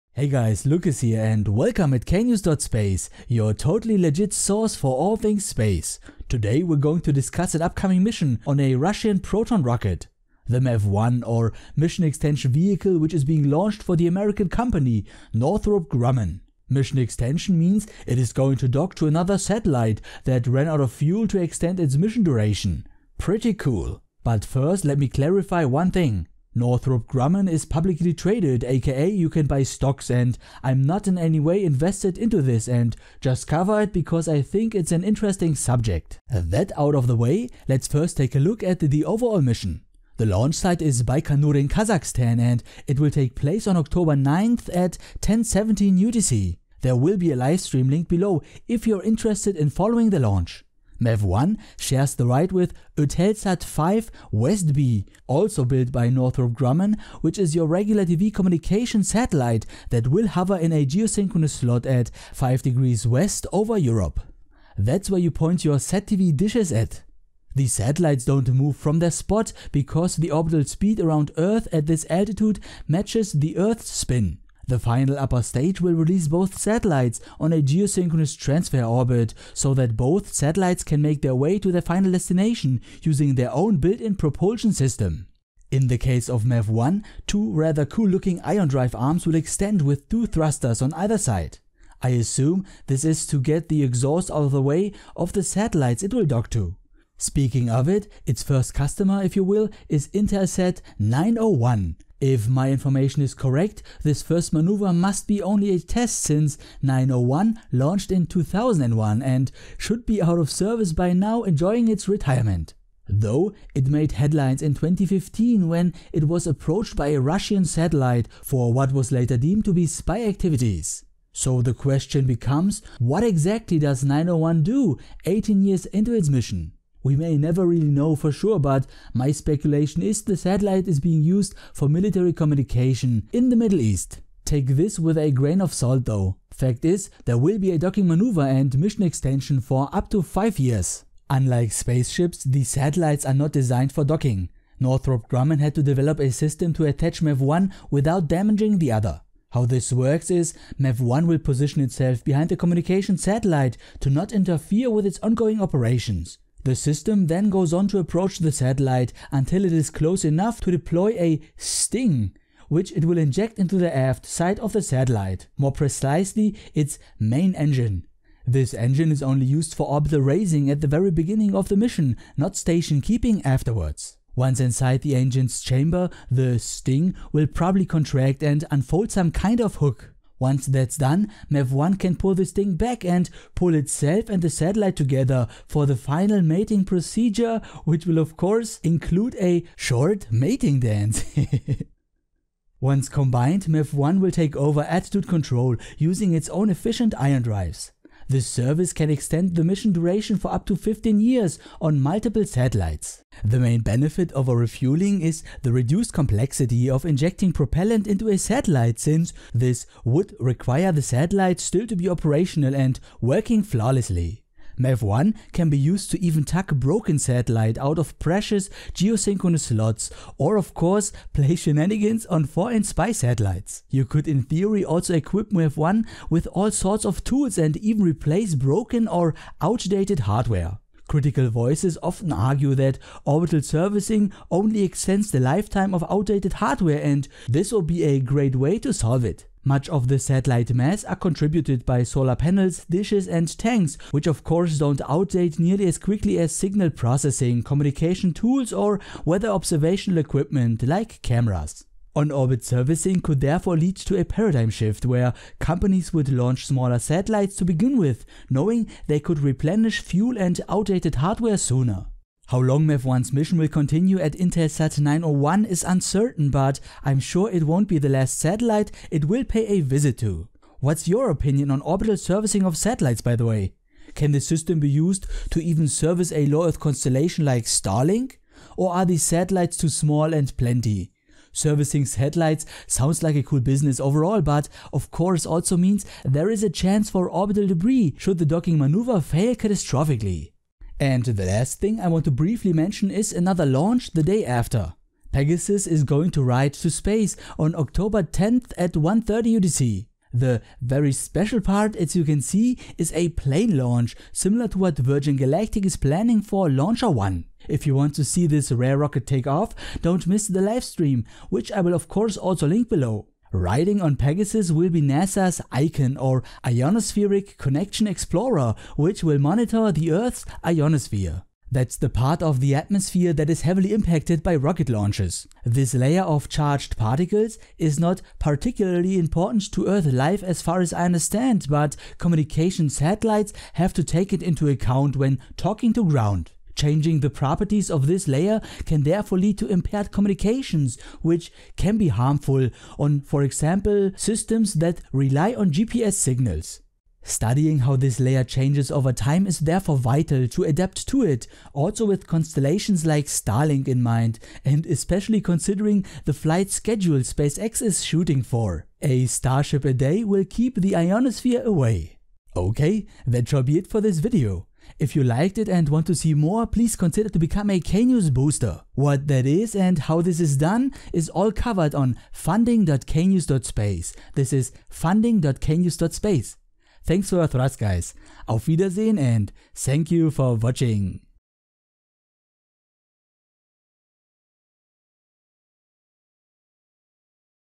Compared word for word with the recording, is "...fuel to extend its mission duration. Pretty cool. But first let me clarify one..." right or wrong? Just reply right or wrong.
right.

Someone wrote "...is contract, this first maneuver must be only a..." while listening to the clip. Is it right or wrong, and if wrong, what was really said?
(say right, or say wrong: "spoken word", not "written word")
wrong: "correct", not "contract".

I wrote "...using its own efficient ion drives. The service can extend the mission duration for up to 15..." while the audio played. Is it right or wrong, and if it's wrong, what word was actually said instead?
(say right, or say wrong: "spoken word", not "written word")
right.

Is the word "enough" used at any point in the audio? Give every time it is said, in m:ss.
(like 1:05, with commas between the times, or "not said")
2:40.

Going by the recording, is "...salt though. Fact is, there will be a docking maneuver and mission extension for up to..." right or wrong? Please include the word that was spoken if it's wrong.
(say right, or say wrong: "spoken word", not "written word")
right.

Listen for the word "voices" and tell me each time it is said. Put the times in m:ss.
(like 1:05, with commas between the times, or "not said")
3:51.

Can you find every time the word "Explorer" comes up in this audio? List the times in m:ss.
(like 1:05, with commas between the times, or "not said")
5:18.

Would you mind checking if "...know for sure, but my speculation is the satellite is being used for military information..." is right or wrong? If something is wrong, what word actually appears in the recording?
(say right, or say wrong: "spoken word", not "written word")
wrong: "communication", not "information".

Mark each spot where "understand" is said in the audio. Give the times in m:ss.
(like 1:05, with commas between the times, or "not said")
5:31.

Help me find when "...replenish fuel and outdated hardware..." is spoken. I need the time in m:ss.
4:19.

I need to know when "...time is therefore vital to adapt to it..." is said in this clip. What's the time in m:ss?
5:49.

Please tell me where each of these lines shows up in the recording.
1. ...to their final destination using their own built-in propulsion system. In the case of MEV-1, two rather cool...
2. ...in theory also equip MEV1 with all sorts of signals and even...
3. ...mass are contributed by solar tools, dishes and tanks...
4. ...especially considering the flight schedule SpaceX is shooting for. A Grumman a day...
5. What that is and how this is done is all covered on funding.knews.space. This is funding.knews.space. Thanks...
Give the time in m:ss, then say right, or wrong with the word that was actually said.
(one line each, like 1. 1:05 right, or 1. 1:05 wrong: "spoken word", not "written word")
1. 1:21 right
2. 3:44 wrong: "tools", not "signals"
3. 4:00 wrong: "panels", not "tools"
4. 5:54 wrong: "Starship", not "Grumman"
5. 6:08 right.